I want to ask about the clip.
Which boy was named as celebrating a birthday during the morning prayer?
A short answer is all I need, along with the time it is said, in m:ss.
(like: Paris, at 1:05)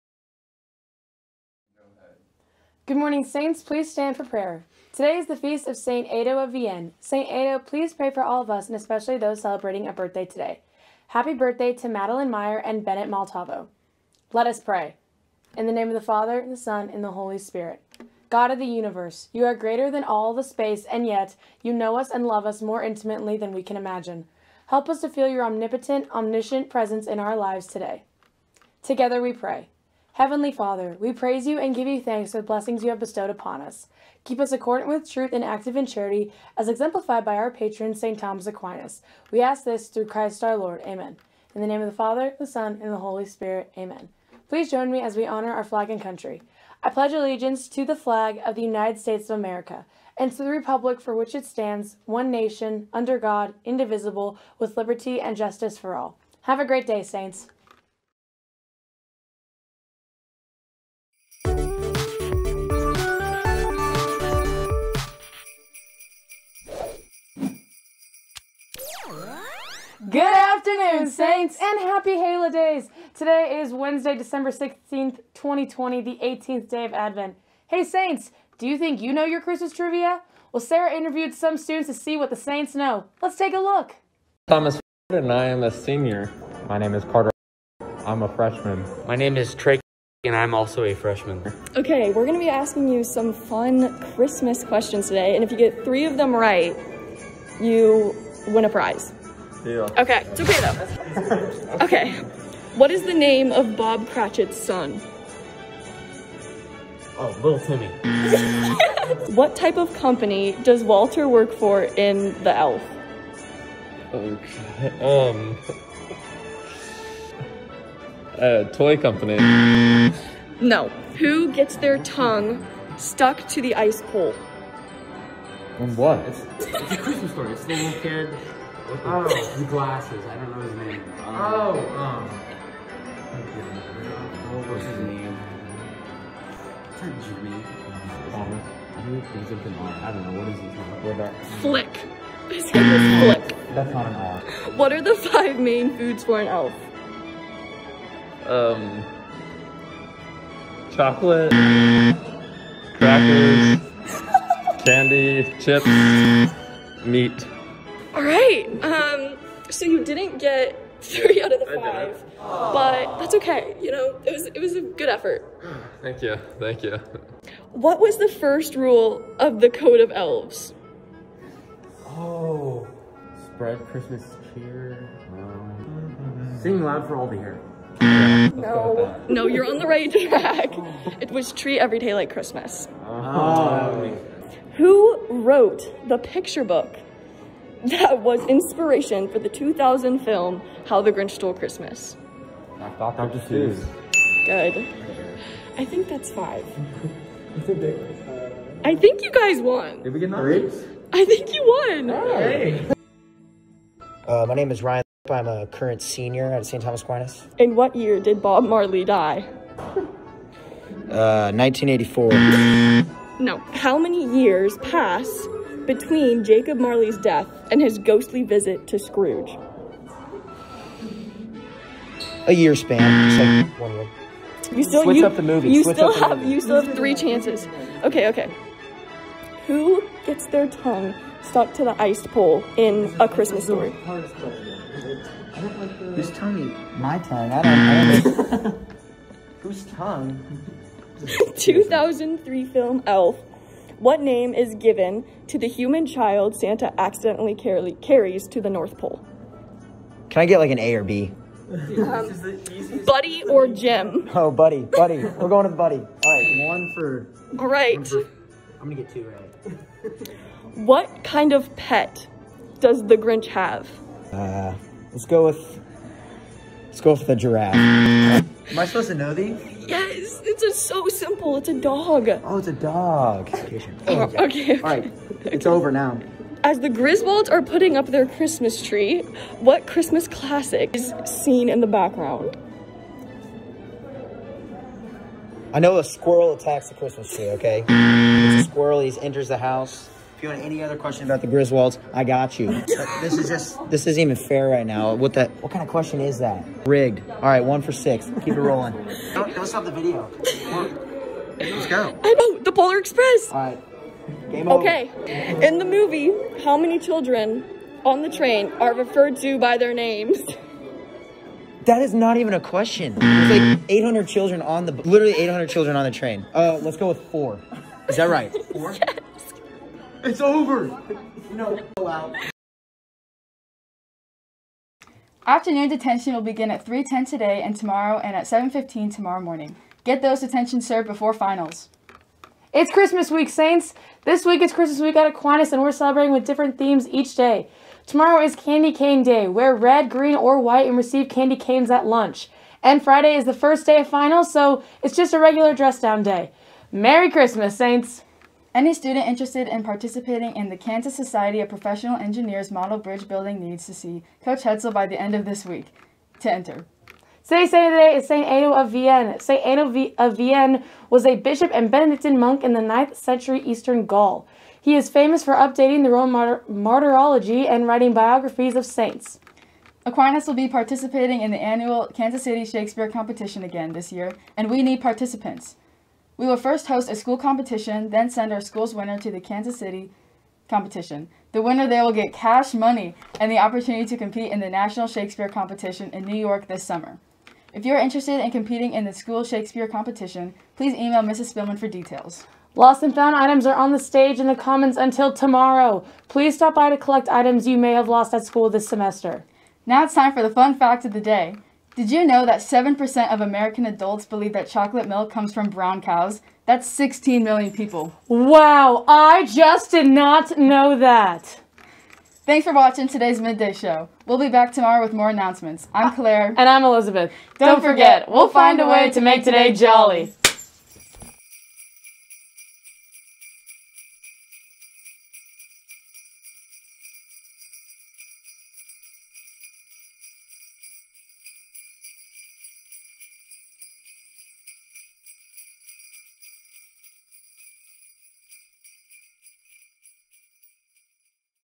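Bennett Maltavo, at 0:12.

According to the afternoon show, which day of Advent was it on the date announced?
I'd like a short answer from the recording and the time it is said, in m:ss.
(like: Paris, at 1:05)
18th, at 1:16.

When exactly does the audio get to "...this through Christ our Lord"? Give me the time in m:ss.
0:39.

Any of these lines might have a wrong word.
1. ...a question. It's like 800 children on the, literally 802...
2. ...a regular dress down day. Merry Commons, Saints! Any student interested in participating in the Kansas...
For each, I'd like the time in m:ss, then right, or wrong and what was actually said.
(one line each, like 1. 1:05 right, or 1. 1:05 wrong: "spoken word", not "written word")
1. 5:12 wrong: "800", not "802"
2. 5:45 wrong: "Christmas", not "Commons".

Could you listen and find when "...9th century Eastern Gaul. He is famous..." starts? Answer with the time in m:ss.
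6:02.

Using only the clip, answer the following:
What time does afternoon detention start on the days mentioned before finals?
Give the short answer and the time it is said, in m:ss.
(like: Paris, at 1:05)
3:10, at 5:26.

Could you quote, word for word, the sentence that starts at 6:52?
Thanks for watching today's Midday Show.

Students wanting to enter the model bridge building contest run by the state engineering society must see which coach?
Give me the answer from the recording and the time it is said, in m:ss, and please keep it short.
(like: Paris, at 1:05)
Coach Hetzel, at 5:54.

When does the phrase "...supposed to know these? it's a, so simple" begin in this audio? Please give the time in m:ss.
4:28.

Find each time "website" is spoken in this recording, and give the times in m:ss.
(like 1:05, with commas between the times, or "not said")
not said.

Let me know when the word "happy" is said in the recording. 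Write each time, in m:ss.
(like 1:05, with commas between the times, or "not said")
0:11, 1:11.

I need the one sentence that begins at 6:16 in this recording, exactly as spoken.
We will first host a school competition, then send our school's winner to the Kansas City competition.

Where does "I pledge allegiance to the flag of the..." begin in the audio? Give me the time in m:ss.
0:46.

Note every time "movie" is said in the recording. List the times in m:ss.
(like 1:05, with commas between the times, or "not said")
3:45, 5:05.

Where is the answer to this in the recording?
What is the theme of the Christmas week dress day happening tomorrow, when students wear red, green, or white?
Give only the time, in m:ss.
5:38.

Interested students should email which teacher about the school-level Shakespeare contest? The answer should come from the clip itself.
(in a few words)
Mrs. Spillman.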